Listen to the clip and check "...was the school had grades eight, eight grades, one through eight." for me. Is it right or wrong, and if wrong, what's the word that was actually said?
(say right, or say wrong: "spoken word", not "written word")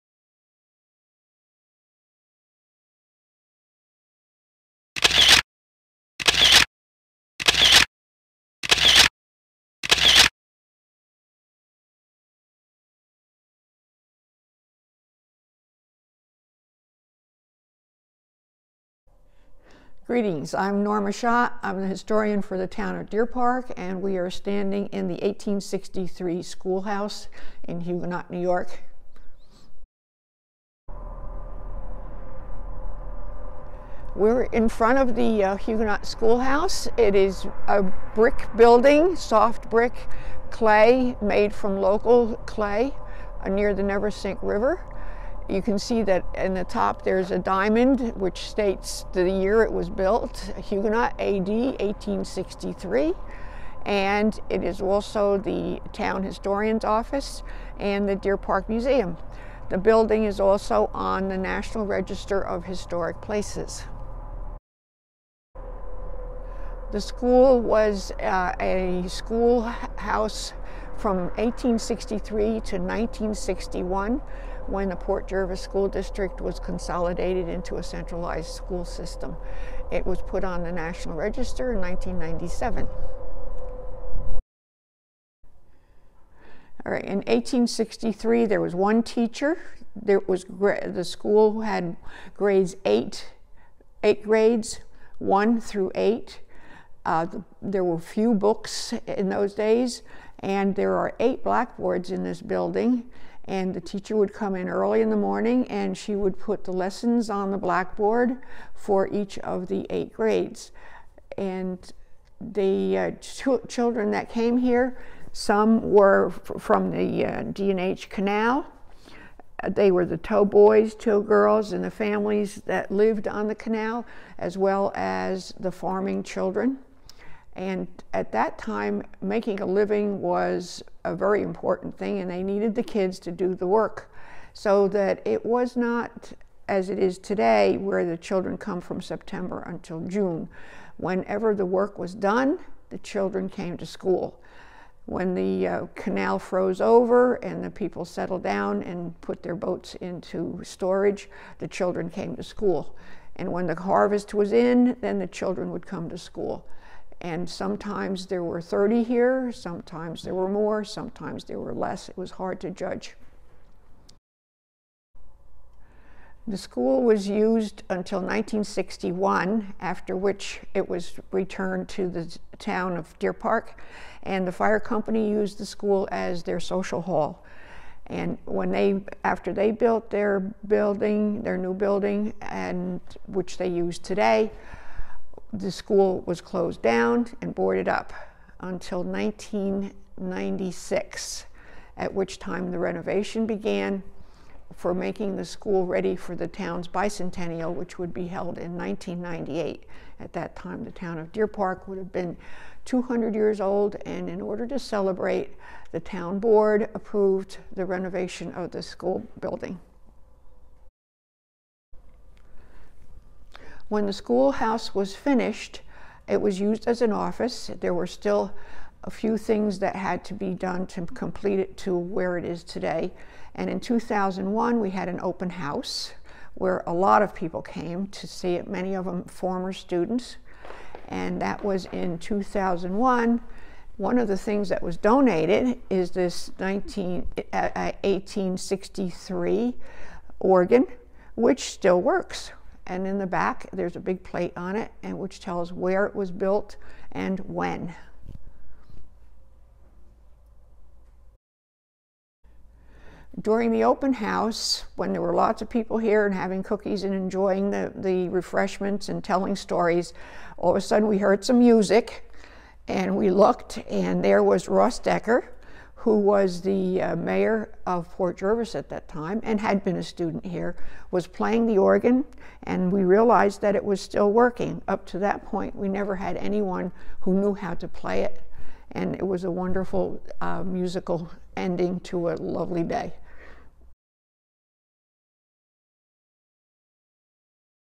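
right.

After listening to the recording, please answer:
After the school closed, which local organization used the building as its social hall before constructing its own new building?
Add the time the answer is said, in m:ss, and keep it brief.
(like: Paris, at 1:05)
the fire company, at 2:54.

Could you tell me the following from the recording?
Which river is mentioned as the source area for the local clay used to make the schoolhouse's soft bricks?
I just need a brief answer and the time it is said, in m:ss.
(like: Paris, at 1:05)
Neversink River, at 0:43.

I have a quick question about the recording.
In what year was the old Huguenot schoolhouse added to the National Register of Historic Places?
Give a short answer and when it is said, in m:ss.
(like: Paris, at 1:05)
1997, at 1:21.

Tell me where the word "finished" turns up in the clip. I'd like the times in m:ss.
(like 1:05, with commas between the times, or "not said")
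3:35.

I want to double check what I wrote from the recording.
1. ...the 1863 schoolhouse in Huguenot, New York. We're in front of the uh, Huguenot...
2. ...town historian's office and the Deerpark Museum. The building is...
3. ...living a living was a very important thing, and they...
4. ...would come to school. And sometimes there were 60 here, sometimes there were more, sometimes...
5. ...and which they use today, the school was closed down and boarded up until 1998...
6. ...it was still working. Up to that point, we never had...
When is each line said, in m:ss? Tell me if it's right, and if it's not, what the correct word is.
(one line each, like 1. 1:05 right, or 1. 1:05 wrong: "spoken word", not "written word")
1. 0:25 right
2. 0:55 right
3. 2:09 wrong: "making", not "living"
4. 2:35 wrong: "30", not "60"
5. 3:02 wrong: "1996", not "1998"
6. 4:33 right.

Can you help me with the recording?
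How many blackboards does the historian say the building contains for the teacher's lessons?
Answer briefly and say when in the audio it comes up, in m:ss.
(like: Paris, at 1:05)
8, at 1:41.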